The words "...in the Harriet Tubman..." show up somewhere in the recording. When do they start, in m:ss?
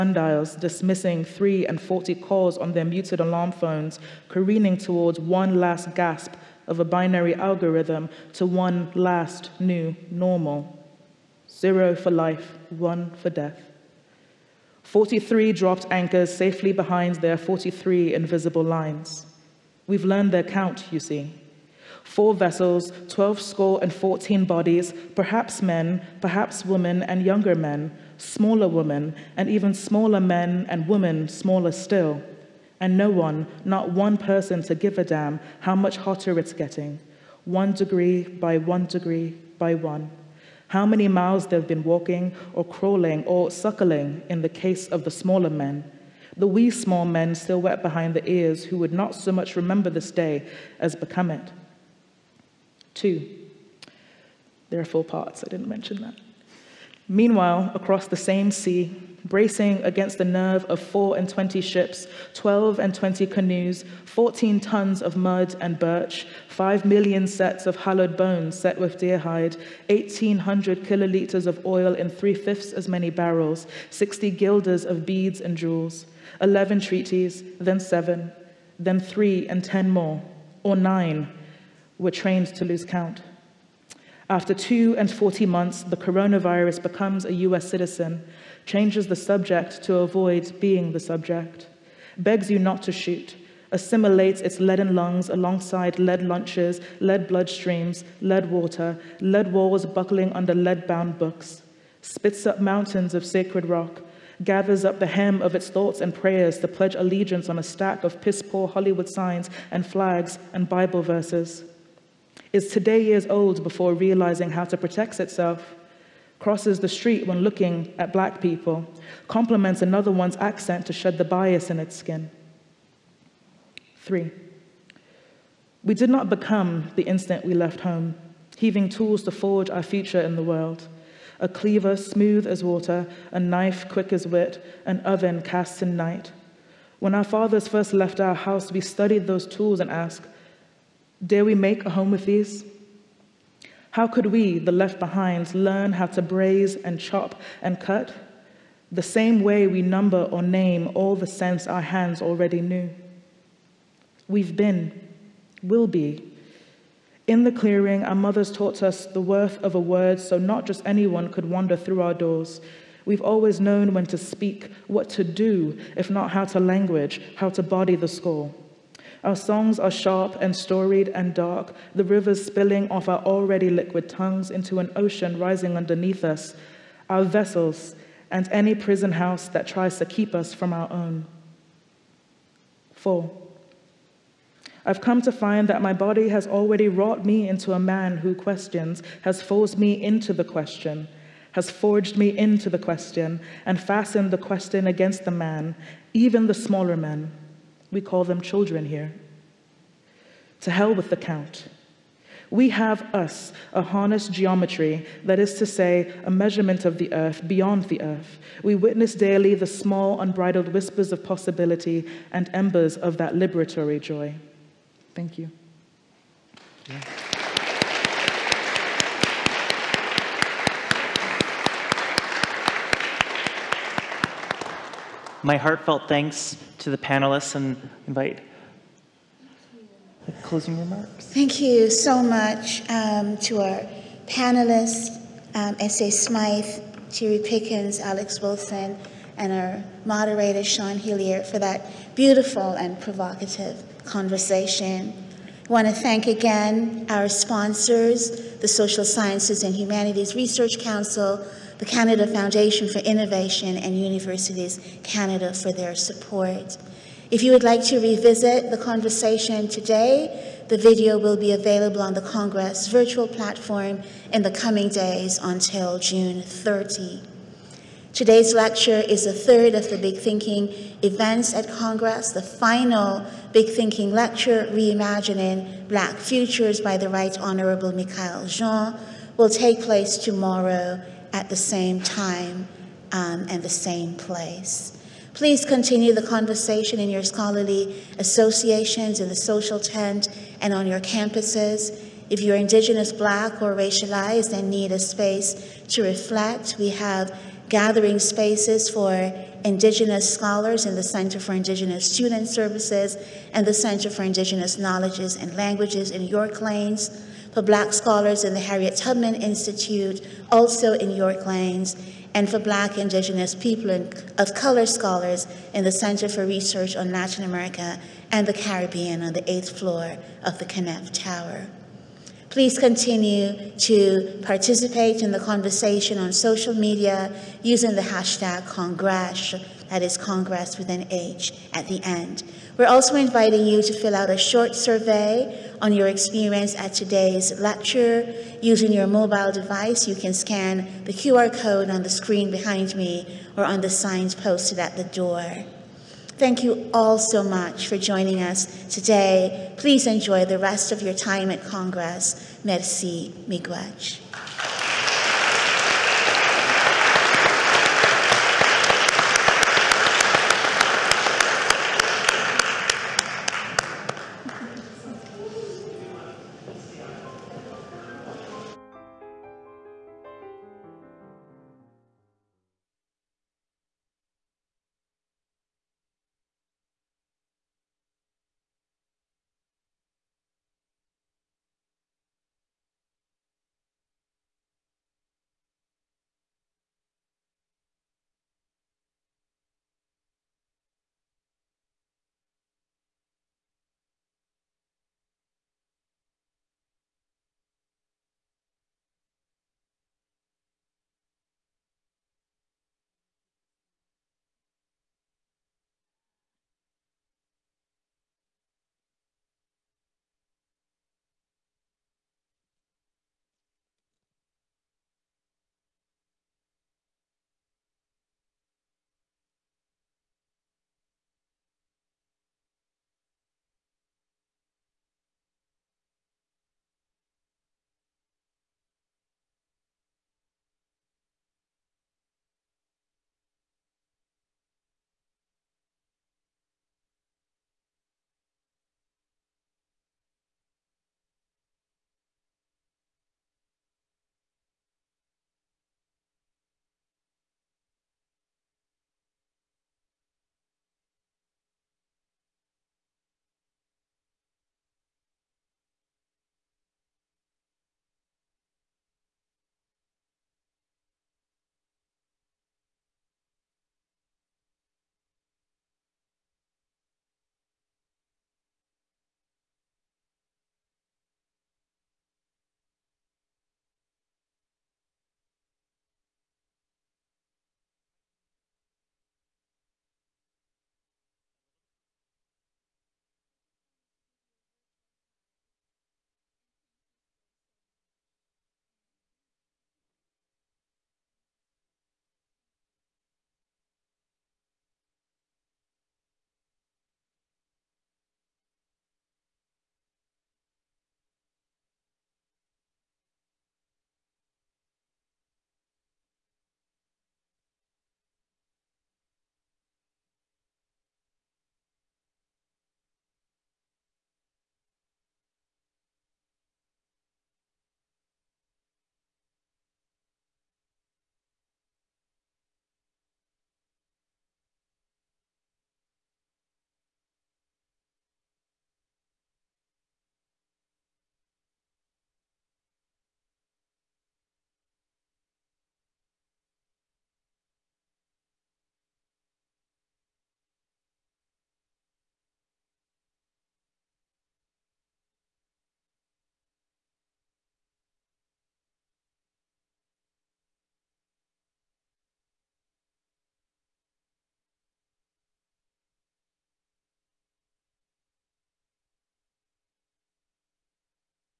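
5:08.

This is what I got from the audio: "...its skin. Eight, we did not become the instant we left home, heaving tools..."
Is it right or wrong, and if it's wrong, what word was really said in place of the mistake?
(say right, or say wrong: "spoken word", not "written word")
wrong: "Three", not "Eight".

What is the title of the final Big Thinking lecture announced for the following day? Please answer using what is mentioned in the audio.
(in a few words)
Reimagining Black Futures.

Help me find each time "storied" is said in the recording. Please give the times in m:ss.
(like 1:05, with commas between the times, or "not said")
2:50.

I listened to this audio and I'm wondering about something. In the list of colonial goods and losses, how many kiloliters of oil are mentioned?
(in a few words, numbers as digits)
1800.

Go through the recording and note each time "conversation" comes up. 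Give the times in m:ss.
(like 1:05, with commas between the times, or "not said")
4:04, 4:18, 4:46, 5:25.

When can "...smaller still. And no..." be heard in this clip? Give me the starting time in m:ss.
0:31.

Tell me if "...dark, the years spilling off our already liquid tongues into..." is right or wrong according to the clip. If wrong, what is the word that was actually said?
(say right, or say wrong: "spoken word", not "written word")
wrong: "rivers", not "years".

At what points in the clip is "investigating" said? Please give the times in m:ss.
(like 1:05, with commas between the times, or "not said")
not said.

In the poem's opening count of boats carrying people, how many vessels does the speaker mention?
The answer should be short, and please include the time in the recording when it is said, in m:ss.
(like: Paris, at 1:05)
4, at 0:22.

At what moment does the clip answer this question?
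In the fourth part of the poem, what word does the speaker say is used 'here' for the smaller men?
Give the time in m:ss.
3:18.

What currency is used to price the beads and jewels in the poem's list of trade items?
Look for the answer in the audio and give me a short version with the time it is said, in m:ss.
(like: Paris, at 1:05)
guilders, at 1:13.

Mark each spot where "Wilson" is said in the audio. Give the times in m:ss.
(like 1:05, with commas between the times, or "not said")
3:58.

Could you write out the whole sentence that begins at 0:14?
43 dropped anchors safely behind their 43 invisible lines.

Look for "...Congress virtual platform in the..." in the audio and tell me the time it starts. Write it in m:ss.
4:22.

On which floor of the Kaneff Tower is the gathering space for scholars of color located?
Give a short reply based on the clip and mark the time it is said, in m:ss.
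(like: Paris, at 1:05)
8th, at 5:19.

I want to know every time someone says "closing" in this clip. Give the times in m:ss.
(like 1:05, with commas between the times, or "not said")
3:50.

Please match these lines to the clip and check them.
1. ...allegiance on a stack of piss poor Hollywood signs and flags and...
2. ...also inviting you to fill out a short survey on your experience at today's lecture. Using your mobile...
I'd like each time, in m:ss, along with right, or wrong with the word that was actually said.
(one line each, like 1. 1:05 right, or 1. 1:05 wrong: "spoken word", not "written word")
1. 1:46 right
2. 5:32 right.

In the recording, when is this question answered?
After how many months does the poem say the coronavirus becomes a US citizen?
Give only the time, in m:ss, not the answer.
1:24.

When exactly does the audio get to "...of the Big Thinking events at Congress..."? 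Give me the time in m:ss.
4:29.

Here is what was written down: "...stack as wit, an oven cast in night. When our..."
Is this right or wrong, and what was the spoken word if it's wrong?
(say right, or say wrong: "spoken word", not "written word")
wrong: "quick", not "stack".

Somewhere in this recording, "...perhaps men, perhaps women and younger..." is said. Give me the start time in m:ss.
0:25.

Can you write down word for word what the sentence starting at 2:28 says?
The same way we number or name all the sense our hands already knew.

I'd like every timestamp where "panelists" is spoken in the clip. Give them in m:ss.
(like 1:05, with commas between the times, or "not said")
3:46, 3:54.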